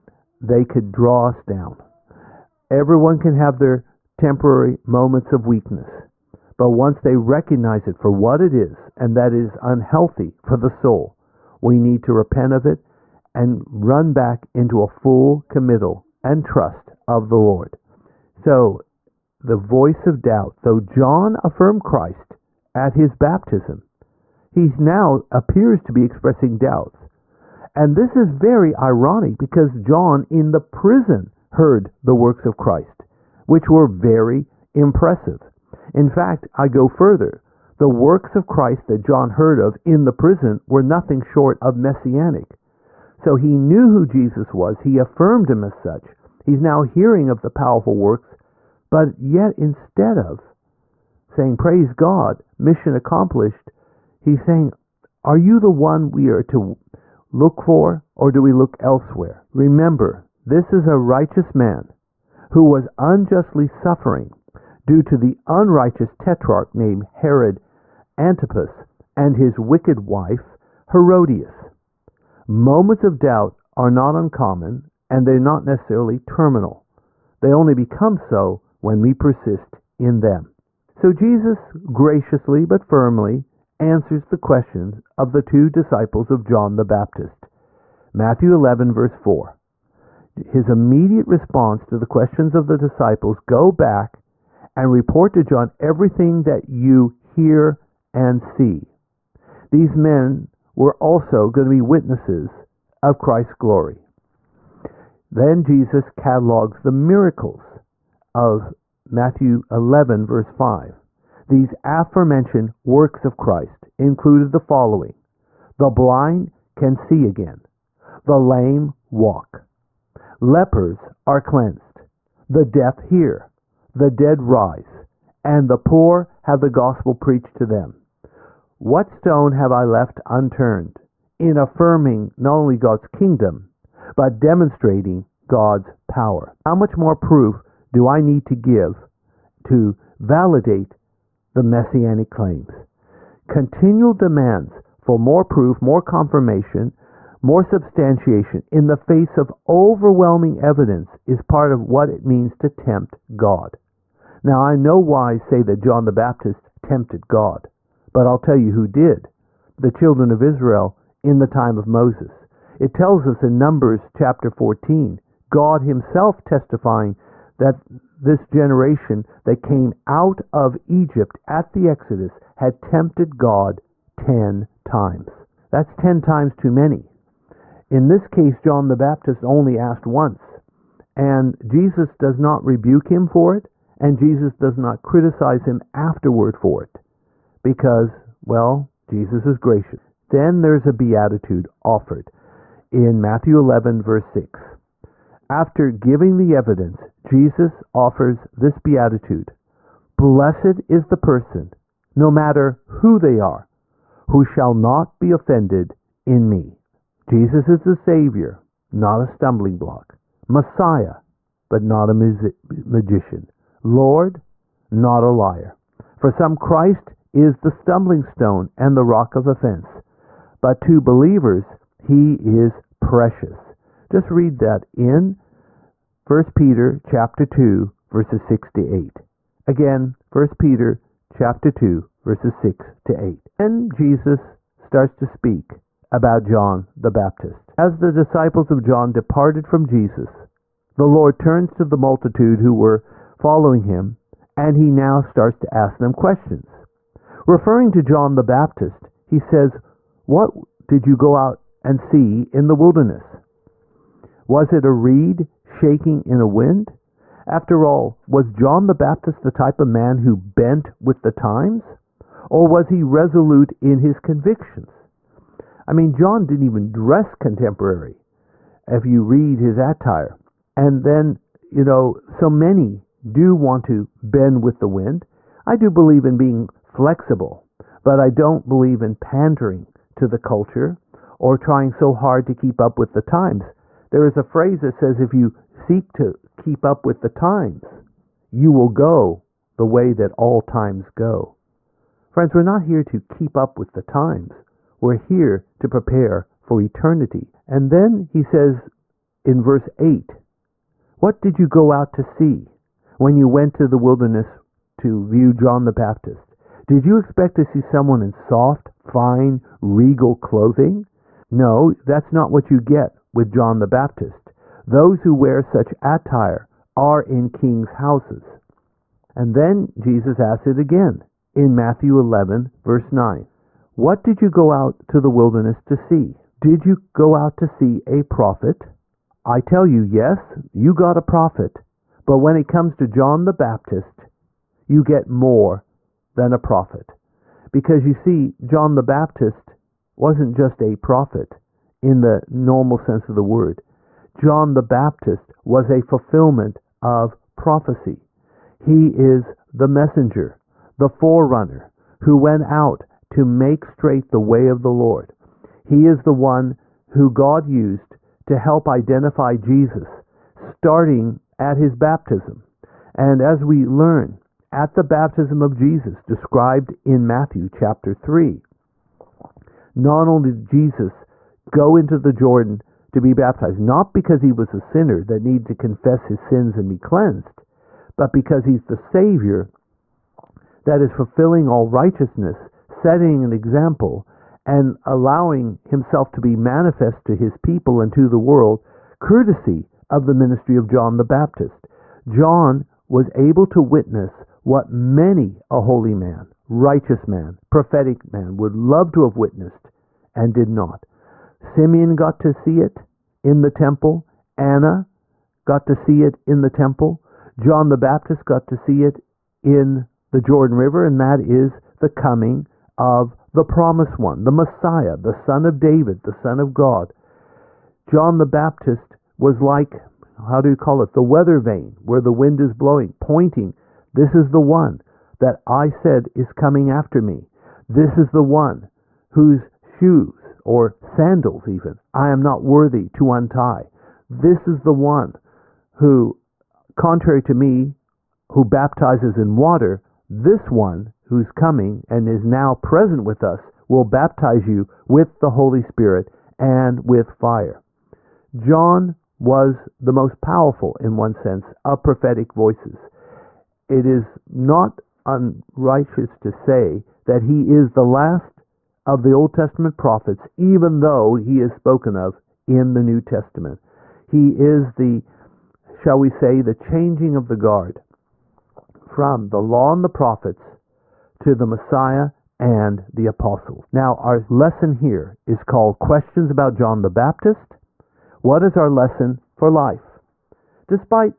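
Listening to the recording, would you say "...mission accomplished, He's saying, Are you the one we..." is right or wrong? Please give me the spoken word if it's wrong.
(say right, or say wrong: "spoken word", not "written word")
right.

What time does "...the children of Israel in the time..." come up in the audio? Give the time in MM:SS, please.
02:39.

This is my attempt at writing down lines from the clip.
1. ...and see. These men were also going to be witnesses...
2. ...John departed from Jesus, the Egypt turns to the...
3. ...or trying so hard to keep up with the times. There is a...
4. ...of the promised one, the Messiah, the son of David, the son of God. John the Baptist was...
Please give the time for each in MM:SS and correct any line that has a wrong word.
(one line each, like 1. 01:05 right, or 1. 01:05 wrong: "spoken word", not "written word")
1. 01:38 right
2. 03:58 wrong: "Lord", not "Egypt"
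3. 04:41 right
4. 06:52 right.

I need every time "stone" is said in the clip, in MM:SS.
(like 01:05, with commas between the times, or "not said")
02:09, 03:38.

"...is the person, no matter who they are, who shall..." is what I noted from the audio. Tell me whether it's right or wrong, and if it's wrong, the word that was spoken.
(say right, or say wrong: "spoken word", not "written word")
right.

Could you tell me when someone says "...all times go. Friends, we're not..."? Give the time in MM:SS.
04:50.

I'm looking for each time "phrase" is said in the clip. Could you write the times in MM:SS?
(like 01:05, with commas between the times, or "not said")
04:44.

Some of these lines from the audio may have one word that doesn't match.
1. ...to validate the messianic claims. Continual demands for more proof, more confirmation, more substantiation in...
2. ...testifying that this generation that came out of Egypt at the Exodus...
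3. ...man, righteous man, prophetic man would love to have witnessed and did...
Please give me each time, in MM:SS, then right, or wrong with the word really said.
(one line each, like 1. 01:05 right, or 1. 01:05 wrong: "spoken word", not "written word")
1. 02:19 right
2. 02:46 right
3. 06:36 right.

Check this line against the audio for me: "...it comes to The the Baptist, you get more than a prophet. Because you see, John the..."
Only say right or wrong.
wrong.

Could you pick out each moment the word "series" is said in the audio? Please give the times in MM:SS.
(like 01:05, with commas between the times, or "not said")
not said.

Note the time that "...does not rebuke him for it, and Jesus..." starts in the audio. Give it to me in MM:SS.
03:02.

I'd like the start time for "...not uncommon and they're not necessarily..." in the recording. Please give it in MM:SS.
01:13.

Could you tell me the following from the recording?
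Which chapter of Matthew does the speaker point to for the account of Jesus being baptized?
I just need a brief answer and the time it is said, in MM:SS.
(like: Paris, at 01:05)
Chapter 3, at 06:07.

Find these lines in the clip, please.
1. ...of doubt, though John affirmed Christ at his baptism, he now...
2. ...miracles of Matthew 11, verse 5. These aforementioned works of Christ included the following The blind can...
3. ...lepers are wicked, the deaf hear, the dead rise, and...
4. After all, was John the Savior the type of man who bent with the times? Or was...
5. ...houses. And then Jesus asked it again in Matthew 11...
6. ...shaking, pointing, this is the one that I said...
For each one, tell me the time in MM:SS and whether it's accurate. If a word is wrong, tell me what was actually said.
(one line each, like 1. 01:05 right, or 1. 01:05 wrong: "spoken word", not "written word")
1. 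00:20 right
2. 01:46 right
3. 02:00 wrong: "cleansed", not "wicked"
4. 04:17 wrong: "Baptist", not "Savior"
5. 05:18 right
6. 07:02 wrong: "blowing", not "shaking".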